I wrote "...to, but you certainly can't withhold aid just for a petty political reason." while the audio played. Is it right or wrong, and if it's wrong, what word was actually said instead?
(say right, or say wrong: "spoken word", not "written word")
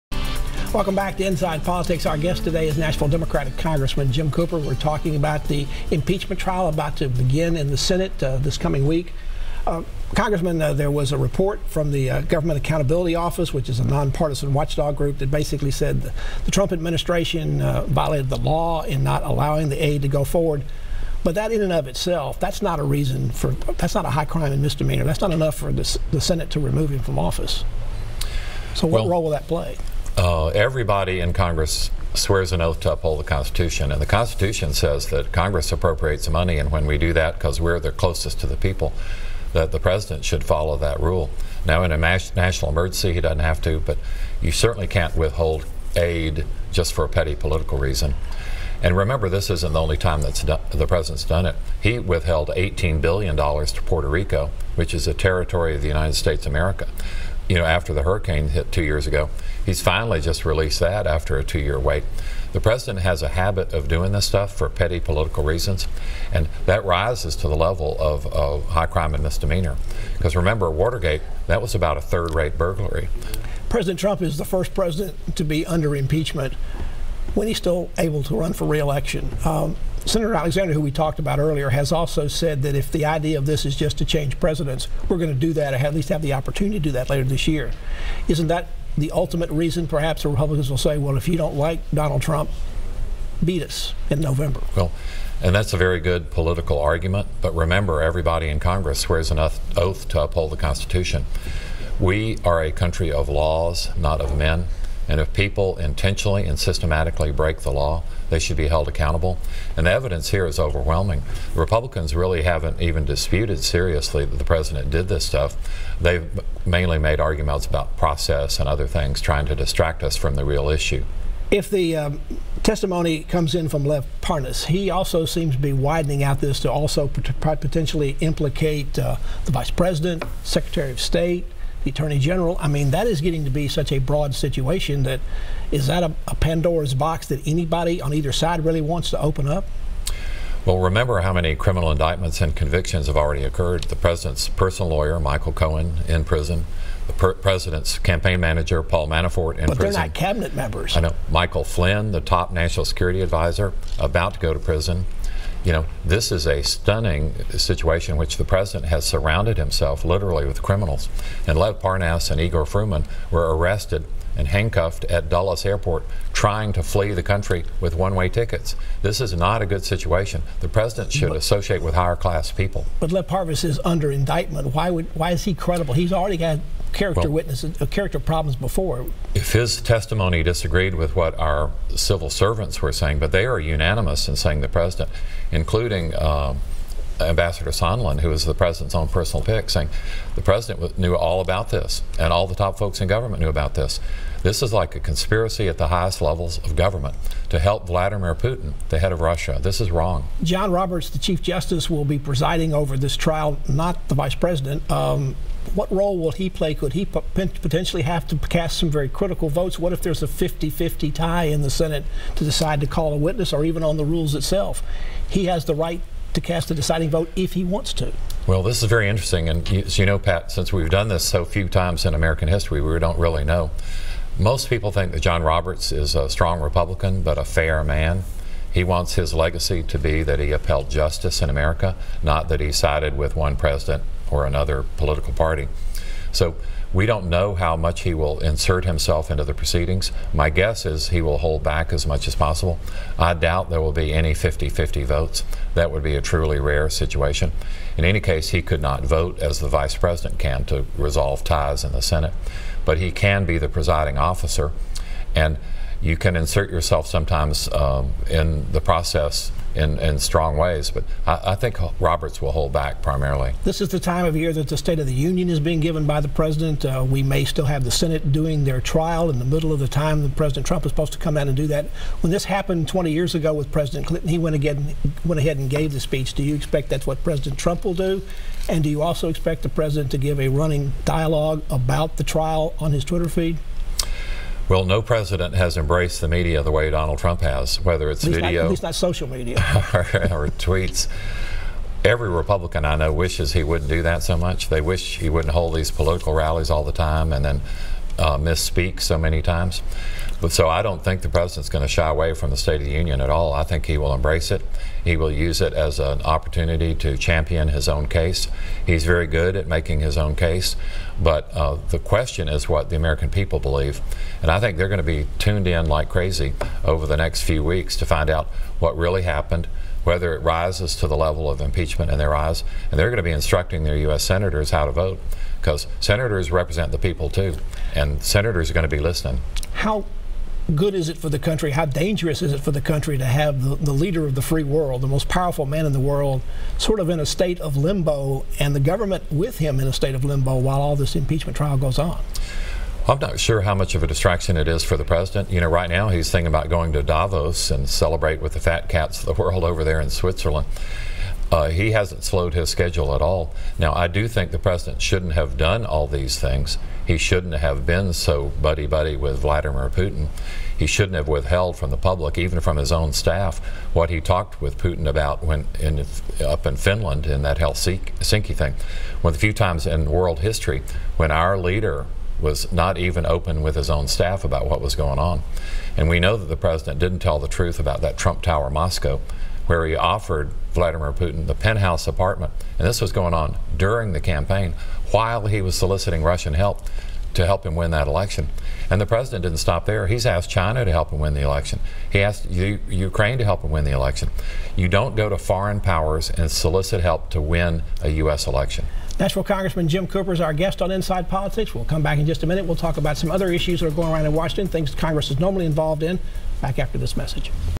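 right.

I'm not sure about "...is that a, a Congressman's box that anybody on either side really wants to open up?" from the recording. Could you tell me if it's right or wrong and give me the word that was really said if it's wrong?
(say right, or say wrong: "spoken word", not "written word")
wrong: "Pandora", not "Congressman".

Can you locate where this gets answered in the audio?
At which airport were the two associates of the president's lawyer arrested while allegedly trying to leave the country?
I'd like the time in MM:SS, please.
02:45.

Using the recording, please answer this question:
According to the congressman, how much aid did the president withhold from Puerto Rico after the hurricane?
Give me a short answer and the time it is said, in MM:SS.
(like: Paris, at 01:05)
$18 billion, at 00:52.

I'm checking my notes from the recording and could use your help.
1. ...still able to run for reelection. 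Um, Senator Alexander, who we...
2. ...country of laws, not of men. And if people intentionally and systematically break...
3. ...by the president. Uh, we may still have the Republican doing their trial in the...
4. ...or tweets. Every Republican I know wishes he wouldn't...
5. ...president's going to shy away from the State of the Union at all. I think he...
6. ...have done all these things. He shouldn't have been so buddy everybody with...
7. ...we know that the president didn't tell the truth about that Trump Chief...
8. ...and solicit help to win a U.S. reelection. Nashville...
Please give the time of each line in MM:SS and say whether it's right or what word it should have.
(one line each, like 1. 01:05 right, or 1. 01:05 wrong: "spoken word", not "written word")
1. 01:17 right
2. 01:42 right
3. 04:26 wrong: "Senate", not "Republican"
4. 04:49 right
5. 05:01 right
6. 05:55 wrong: "buddy", not "everybody"
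7. 06:16 wrong: "Tower", not "Chief"
8. 06:36 wrong: "election", not "reelection".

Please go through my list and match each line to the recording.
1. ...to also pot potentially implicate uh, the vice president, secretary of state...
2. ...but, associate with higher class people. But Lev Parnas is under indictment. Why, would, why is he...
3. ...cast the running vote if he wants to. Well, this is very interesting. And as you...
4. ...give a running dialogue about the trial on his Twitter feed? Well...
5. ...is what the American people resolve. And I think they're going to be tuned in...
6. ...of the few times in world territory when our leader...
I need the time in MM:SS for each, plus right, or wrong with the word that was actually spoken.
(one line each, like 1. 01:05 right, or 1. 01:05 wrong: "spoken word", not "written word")
1. 02:06 right
2. 02:51 right
3. 03:36 wrong: "deciding", not "running"
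4. 04:40 right
5. 05:12 wrong: "believe", not "resolve"
6. 06:09 wrong: "history", not "territory".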